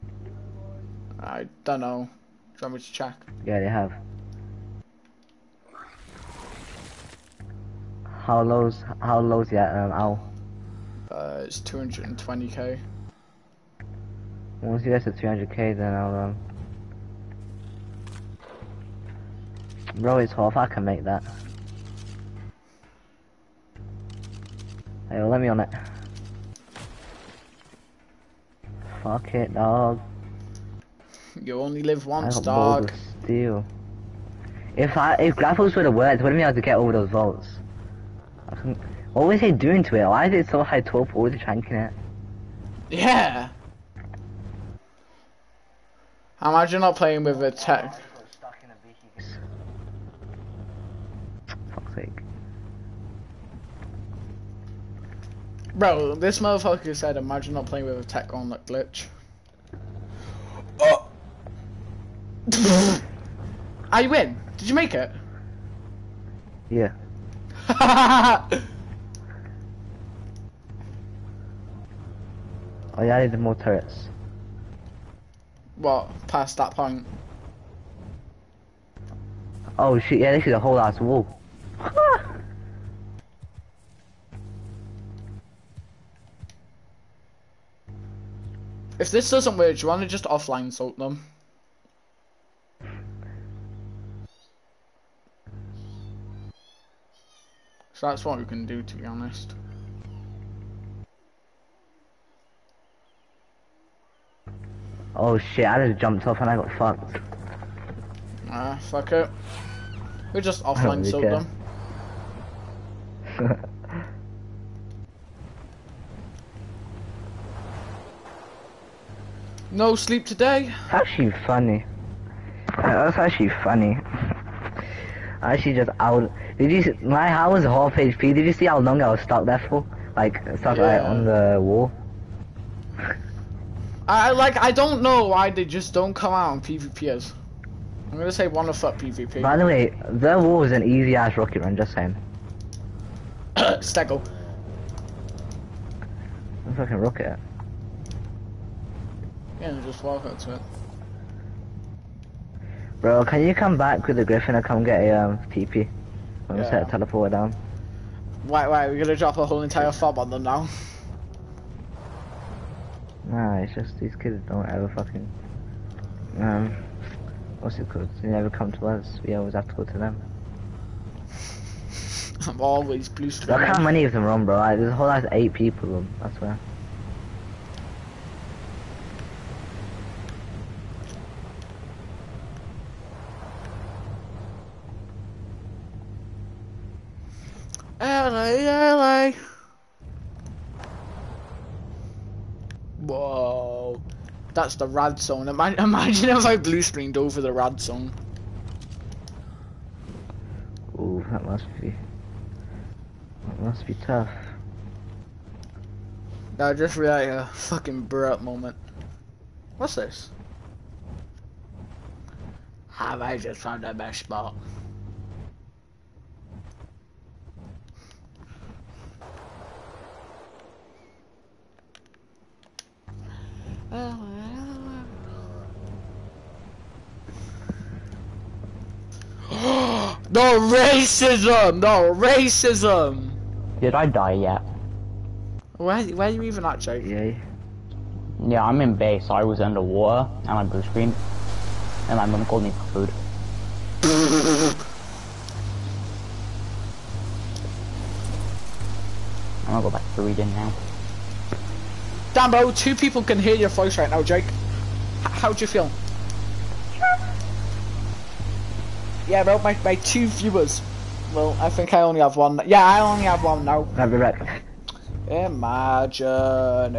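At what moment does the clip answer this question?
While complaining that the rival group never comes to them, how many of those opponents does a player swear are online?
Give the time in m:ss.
2:55.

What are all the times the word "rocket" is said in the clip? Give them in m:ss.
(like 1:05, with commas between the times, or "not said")
2:21, 2:26.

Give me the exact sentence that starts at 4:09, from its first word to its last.
I'm gonna go back to reading now.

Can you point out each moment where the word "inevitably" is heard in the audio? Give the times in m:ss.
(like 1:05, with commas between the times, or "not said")
not said.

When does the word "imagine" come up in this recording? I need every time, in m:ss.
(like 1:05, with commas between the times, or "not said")
0:46, 0:57, 3:15, 4:25.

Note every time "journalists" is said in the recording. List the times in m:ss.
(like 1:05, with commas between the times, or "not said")
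not said.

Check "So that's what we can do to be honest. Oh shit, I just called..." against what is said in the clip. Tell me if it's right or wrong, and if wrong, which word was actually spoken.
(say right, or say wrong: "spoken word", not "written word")
wrong: "jumped", not "called".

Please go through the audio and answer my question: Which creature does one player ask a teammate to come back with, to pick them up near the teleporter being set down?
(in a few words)
griffin.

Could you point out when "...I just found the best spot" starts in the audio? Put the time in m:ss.
3:33.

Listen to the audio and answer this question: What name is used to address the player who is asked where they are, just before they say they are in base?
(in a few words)
JJ.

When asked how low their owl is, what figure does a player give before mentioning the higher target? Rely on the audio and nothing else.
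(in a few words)
220k.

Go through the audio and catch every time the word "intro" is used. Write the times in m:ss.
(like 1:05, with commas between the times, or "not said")
not said.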